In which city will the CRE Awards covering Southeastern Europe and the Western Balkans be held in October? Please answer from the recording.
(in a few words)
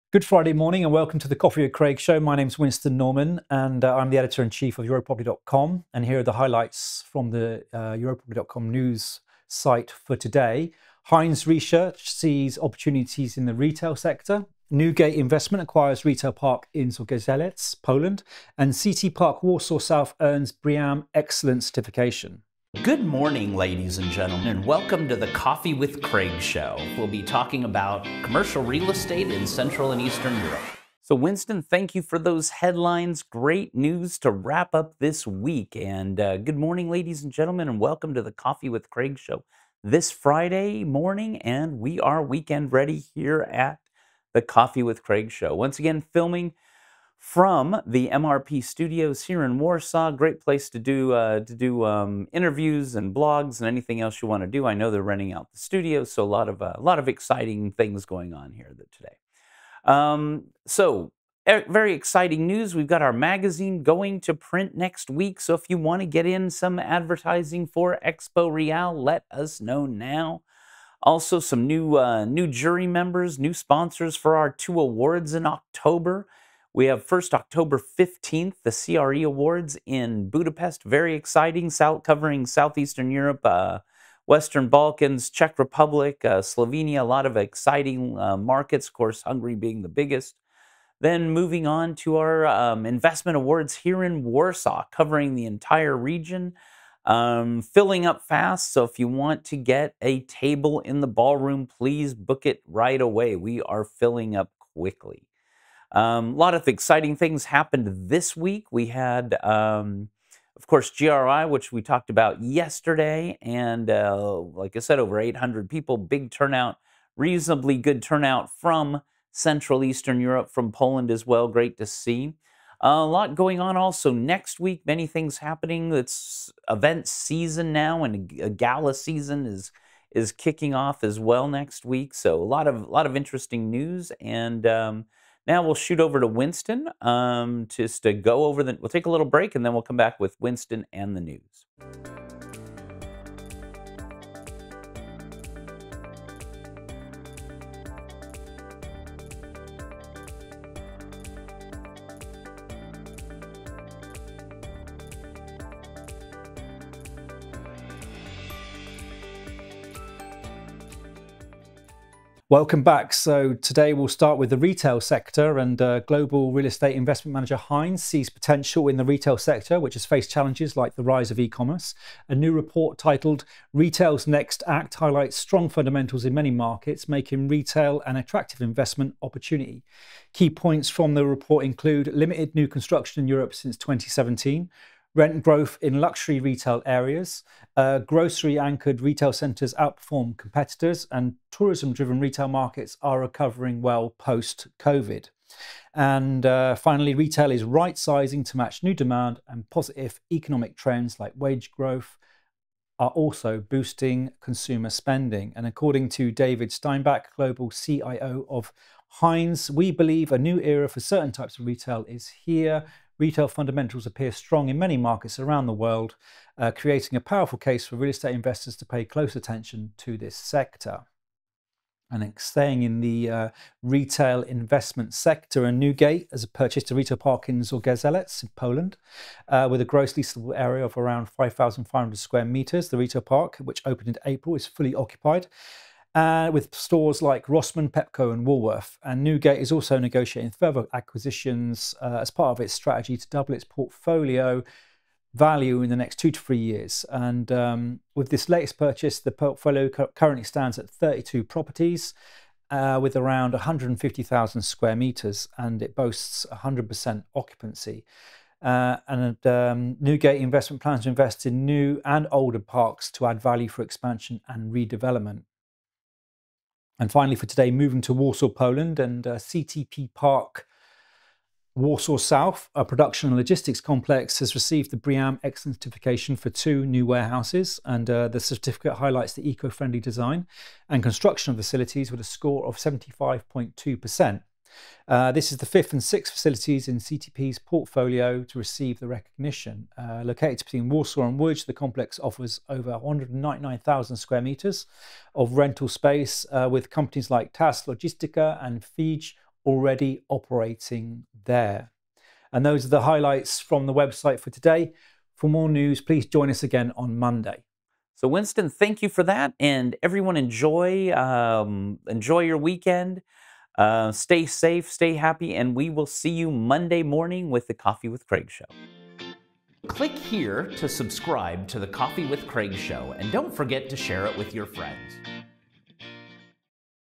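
Budapest.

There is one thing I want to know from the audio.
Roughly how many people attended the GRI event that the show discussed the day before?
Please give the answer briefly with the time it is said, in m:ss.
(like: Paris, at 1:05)
over 800, at 1:54.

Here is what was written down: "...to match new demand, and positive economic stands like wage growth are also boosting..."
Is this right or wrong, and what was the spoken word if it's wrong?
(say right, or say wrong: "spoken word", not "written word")
wrong: "trends", not "stands".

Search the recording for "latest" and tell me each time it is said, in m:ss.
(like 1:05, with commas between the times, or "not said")
4:08.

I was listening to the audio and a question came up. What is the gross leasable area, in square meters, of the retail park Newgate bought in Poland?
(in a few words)
5,500.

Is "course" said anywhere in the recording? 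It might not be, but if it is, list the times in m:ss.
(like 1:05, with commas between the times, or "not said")
1:28, 1:50.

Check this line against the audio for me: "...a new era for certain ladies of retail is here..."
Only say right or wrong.
wrong.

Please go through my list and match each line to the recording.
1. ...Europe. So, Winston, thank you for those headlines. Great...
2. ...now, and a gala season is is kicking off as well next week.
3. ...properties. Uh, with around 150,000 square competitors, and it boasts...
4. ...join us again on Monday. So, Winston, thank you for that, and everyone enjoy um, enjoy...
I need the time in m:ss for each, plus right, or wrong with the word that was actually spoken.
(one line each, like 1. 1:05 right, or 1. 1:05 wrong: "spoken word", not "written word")
1. 0:30 right
2. 2:07 right
3. 4:11 wrong: "meters", not "competitors"
4. 5:06 right.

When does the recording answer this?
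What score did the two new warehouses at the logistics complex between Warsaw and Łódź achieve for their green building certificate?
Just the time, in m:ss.
4:42.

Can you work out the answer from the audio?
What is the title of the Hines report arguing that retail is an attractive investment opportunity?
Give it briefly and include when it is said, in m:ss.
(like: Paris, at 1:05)
Retail's Next Act, at 2:53.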